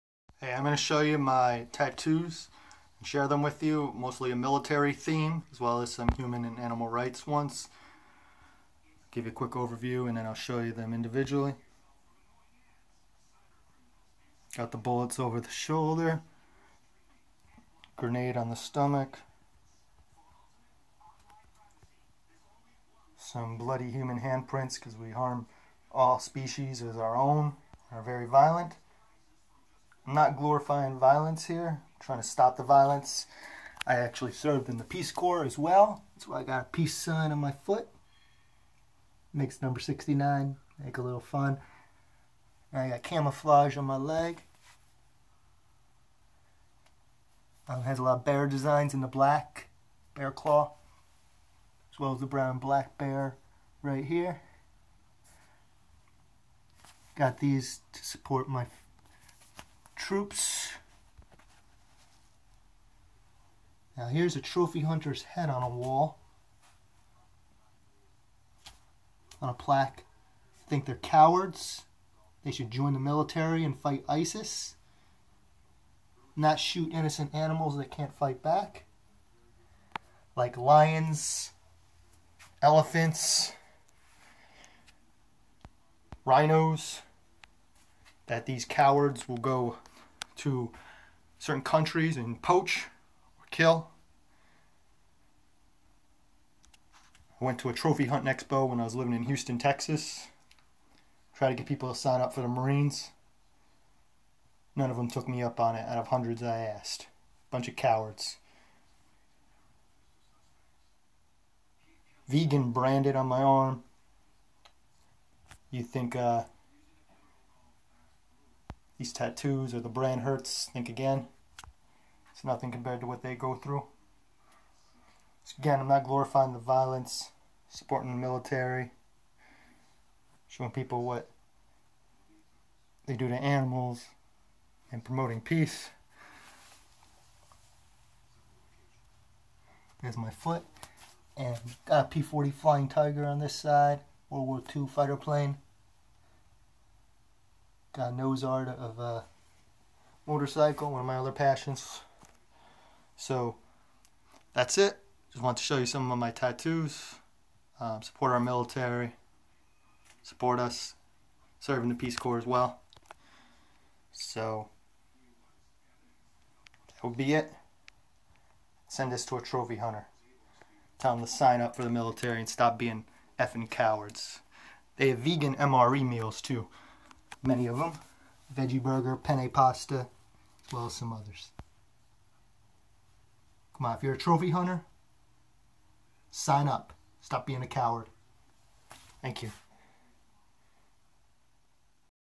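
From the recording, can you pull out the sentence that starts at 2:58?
Veggie burger, penne pasta, as well as some others.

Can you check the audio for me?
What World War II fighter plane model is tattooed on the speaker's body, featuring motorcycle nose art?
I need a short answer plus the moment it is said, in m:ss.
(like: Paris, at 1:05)
P-40 Flying Tiger, at 2:22.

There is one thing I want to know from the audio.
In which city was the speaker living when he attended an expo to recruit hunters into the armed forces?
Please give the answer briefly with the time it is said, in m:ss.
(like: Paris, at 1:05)
Houston, Texas, at 1:39.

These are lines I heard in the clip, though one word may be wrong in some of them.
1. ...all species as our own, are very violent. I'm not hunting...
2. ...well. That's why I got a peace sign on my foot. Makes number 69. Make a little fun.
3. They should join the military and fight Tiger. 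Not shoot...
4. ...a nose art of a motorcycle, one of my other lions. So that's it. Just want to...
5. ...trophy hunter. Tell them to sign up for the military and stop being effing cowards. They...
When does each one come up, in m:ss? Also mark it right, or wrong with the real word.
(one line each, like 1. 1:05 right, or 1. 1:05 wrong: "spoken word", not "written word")
1. 0:25 wrong: "glorifying", not "hunting"
2. 0:35 right
3. 1:12 wrong: "ISIS", not "Tiger"
4. 2:28 wrong: "passions", not "lions"
5. 2:49 right.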